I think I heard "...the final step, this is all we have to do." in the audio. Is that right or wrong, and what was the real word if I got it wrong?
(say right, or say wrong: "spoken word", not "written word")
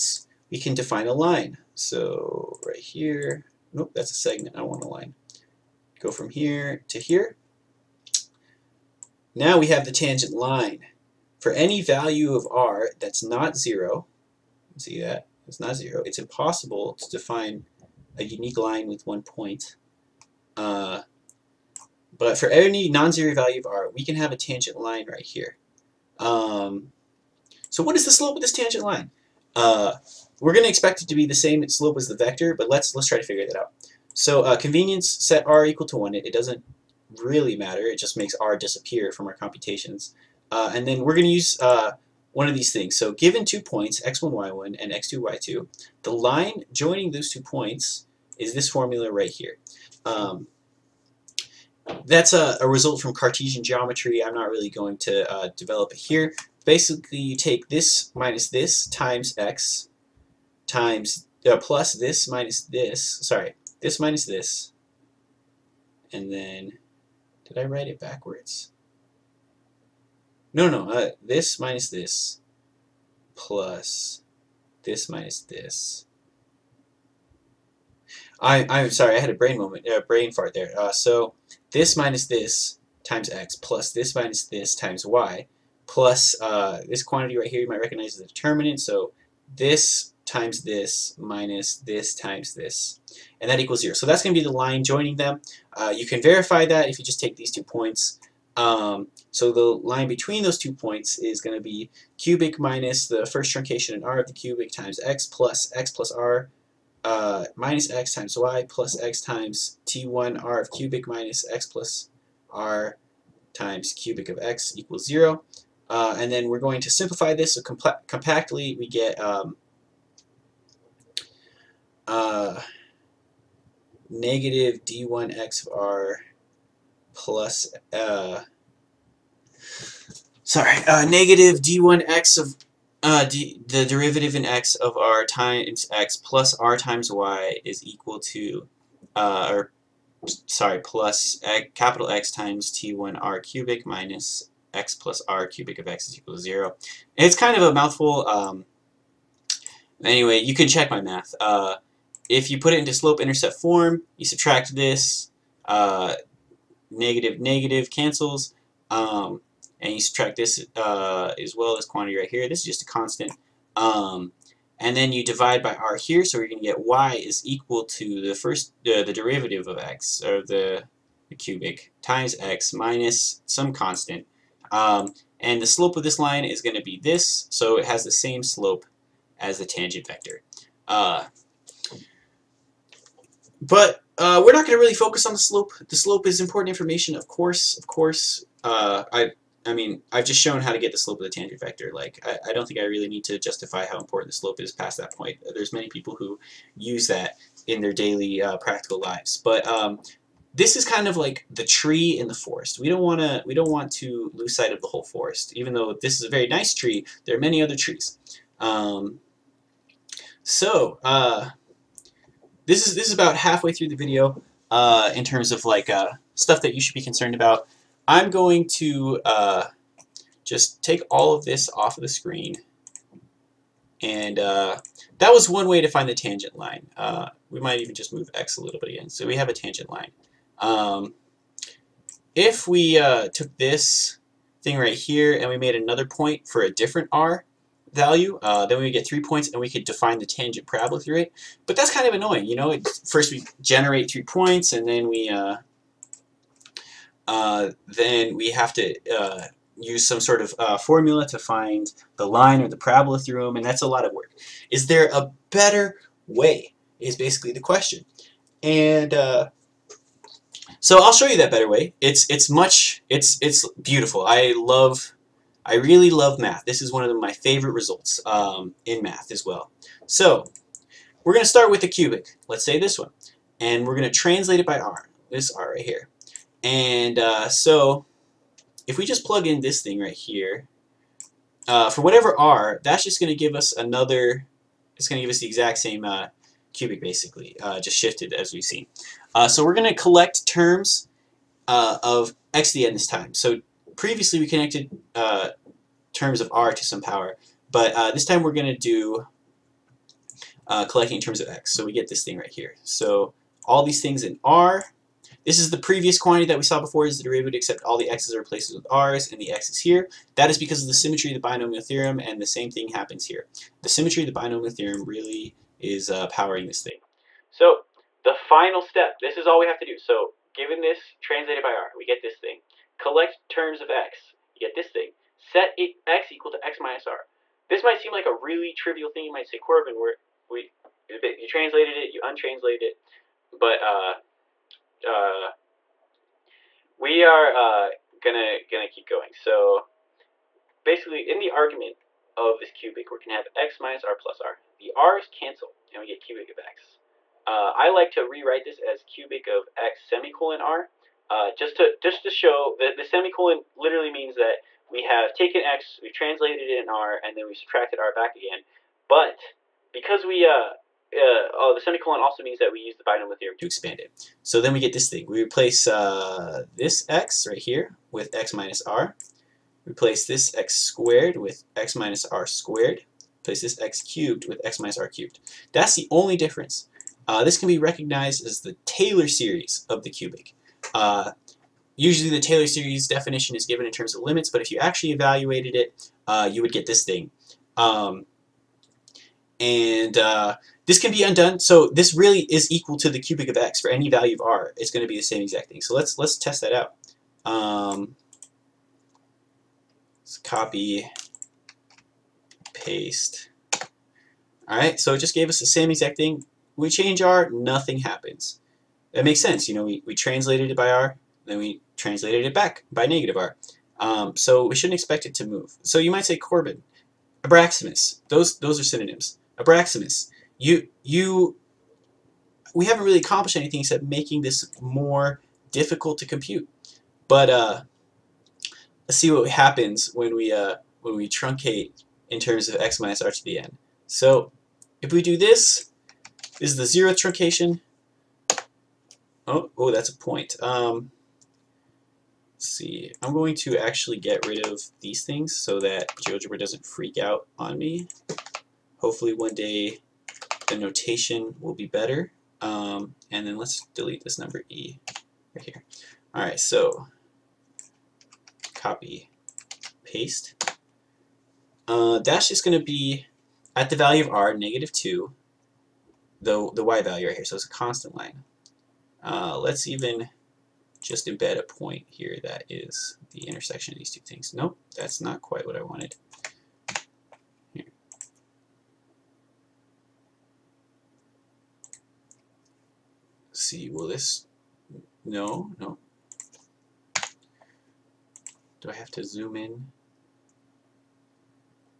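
right.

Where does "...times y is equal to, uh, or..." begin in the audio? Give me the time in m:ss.
2:16.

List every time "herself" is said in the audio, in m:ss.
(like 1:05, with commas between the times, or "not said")
not said.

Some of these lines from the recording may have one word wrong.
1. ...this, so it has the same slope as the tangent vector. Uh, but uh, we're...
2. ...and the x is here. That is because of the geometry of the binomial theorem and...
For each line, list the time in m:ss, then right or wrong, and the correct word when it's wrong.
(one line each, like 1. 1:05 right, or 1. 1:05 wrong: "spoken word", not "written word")
1. 2:57 right
2. 5:09 wrong: "symmetry", not "geometry".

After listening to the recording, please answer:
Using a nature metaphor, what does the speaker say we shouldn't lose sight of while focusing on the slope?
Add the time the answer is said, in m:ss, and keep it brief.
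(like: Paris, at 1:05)
the whole forest, at 3:24.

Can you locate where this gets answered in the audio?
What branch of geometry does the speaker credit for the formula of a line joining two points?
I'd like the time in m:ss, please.
0:53.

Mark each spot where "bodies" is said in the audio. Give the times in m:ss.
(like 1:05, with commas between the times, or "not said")
not said.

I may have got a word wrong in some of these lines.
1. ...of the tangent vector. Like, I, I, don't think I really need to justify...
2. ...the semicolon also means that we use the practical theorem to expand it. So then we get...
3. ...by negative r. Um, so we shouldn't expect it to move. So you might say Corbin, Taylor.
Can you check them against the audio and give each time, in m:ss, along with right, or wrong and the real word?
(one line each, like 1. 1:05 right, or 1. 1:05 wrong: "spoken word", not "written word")
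1. 3:11 right
2. 6:01 wrong: "binomial", not "practical"
3. 6:52 wrong: "Abraxas", not "Taylor".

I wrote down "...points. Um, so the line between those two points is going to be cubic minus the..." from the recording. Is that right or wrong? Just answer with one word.
right.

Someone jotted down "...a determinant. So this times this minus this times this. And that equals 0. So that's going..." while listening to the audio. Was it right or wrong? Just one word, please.
right.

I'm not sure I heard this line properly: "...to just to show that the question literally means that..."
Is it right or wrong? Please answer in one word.
wrong.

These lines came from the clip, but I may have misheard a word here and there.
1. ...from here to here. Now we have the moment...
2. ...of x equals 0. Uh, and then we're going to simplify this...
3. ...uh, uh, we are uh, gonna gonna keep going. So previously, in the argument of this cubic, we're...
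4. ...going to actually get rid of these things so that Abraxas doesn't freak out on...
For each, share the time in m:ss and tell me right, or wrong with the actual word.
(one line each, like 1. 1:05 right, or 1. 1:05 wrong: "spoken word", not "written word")
1. 0:06 wrong: "tangent", not "moment"
2. 1:54 right
3. 5:33 wrong: "basically", not "previously"
4. 7:23 wrong: "GeoGebra", not "Abraxas".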